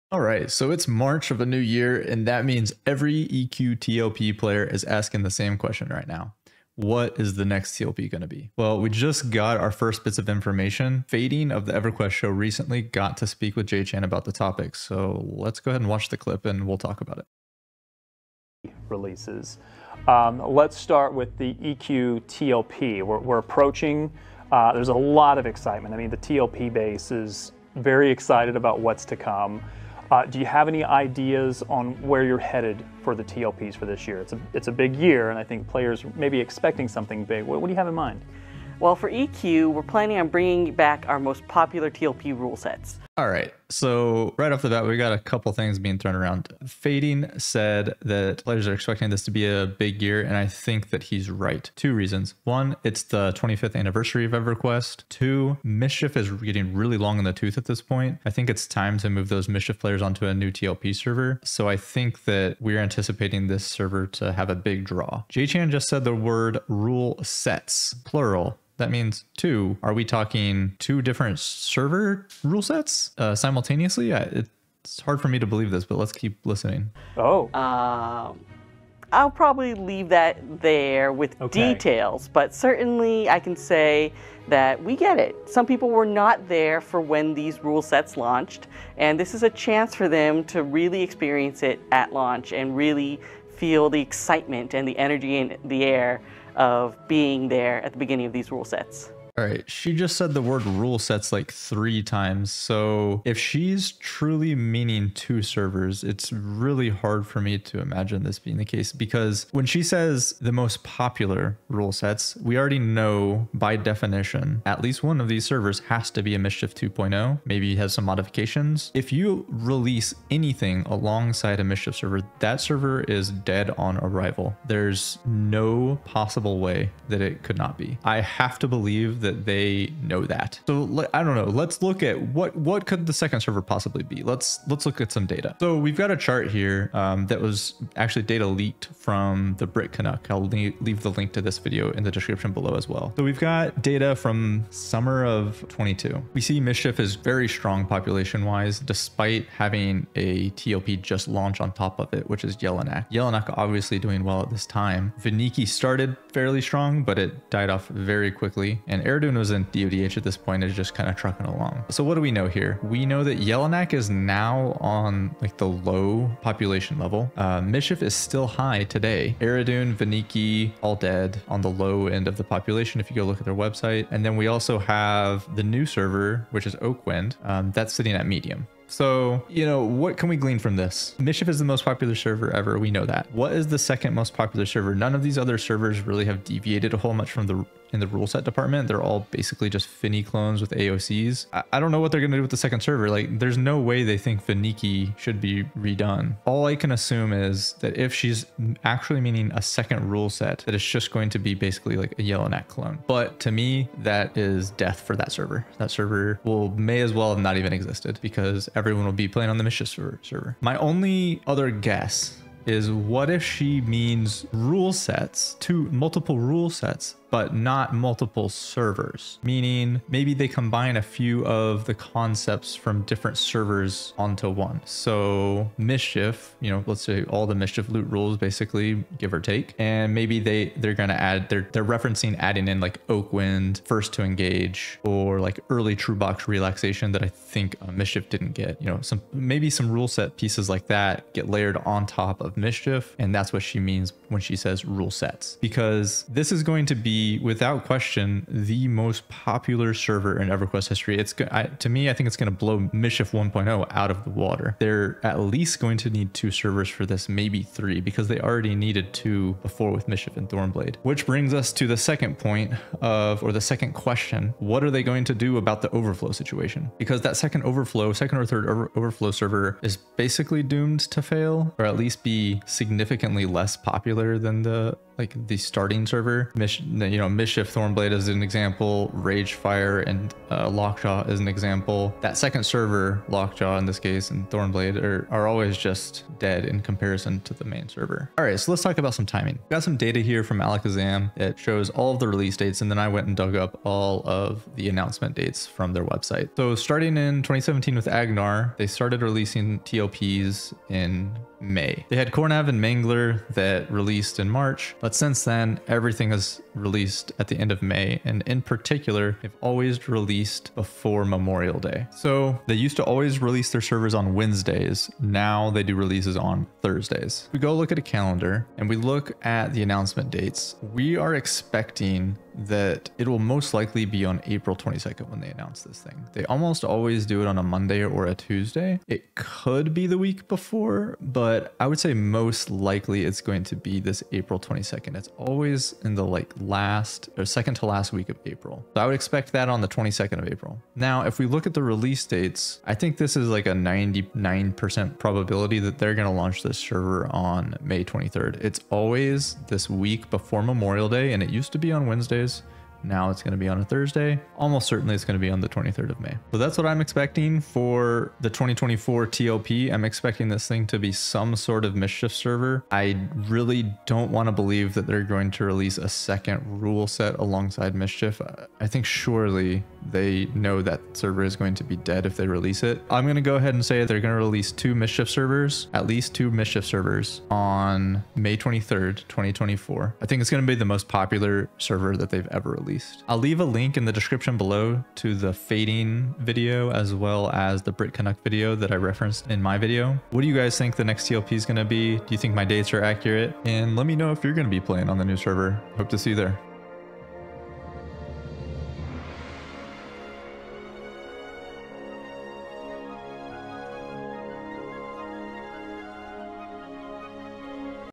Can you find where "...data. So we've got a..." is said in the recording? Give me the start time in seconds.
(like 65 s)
135 s.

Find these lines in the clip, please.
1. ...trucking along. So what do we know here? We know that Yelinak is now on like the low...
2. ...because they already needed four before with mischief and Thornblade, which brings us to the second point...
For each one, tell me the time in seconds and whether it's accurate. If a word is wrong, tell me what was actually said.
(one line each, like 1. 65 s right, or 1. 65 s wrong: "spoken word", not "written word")
1. 161 s right
2. 258 s wrong: "two", not "four".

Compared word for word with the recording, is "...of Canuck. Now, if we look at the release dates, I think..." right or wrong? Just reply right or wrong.
wrong.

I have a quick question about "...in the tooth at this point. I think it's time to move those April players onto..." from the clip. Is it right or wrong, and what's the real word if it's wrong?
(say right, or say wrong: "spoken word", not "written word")
wrong: "Mischief", not "April".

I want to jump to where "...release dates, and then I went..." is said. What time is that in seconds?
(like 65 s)
292 s.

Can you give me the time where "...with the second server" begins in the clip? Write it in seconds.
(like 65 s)
192 s.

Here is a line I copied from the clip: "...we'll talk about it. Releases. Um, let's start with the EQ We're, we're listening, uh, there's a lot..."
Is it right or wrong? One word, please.
wrong.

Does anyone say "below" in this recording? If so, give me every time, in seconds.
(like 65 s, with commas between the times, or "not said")
142 s, 384 s.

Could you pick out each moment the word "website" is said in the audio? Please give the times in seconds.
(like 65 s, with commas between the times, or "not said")
173 s, 296 s.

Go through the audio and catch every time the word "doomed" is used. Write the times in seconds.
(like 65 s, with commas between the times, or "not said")
270 s.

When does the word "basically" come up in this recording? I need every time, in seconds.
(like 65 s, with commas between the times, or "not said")
189 s, 201 s, 228 s, 270 s.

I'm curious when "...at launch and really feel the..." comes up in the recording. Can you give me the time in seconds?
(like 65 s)
91 s.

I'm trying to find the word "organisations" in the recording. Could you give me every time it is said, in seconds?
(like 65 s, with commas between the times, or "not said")
not said.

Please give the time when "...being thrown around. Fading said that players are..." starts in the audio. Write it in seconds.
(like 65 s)
45 s.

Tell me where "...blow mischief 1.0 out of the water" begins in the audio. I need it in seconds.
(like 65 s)
252 s.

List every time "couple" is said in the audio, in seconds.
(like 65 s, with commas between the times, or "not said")
45 s.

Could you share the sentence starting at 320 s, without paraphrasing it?
We are expecting that it will most likely be on April 22nd when they announce this thing.